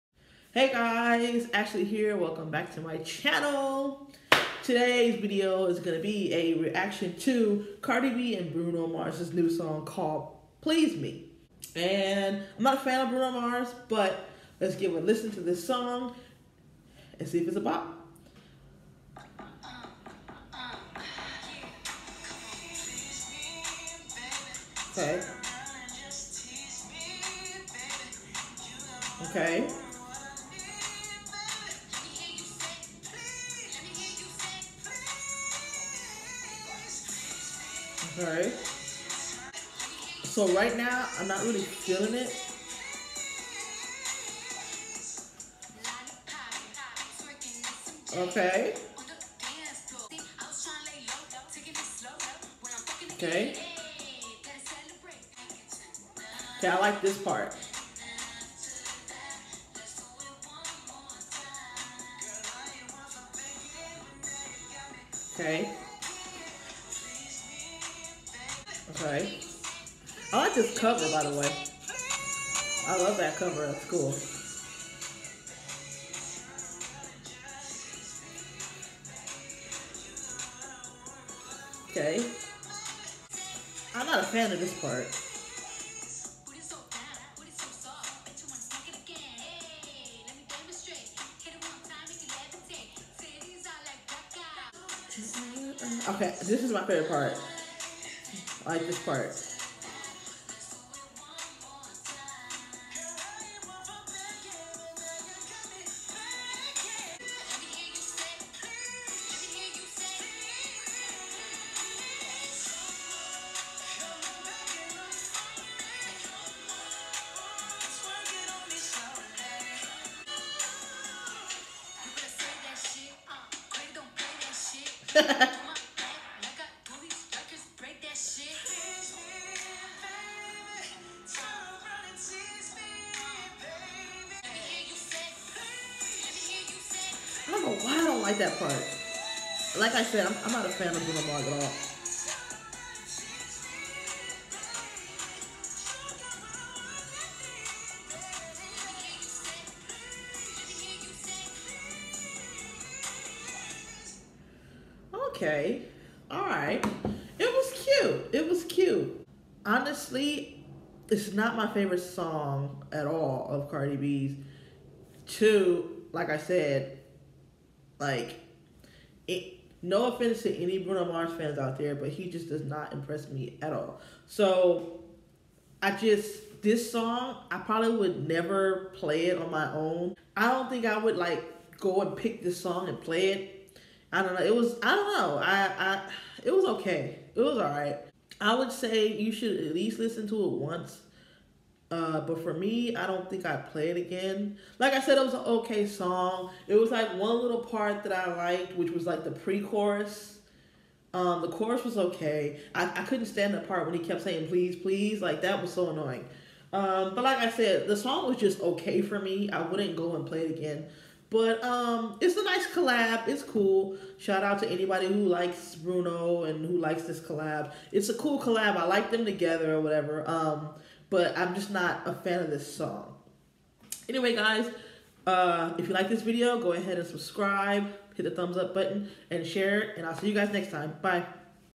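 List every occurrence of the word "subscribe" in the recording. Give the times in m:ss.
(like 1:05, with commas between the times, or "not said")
3:47.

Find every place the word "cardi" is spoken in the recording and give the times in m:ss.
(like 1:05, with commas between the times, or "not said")
0:07, 2:43.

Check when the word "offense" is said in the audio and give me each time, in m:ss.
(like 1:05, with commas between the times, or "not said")
2:50.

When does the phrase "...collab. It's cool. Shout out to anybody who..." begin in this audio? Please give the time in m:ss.
3:32.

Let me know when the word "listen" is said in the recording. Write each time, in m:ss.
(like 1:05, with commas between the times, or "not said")
0:14, 3:09.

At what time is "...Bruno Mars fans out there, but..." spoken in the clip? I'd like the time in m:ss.
2:50.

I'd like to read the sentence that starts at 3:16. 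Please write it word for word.
It was like one little part that I liked, which was like the pre-chorus.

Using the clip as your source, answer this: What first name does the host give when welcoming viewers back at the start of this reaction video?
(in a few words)
Ashley.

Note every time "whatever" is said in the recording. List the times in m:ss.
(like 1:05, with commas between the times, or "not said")
3:39.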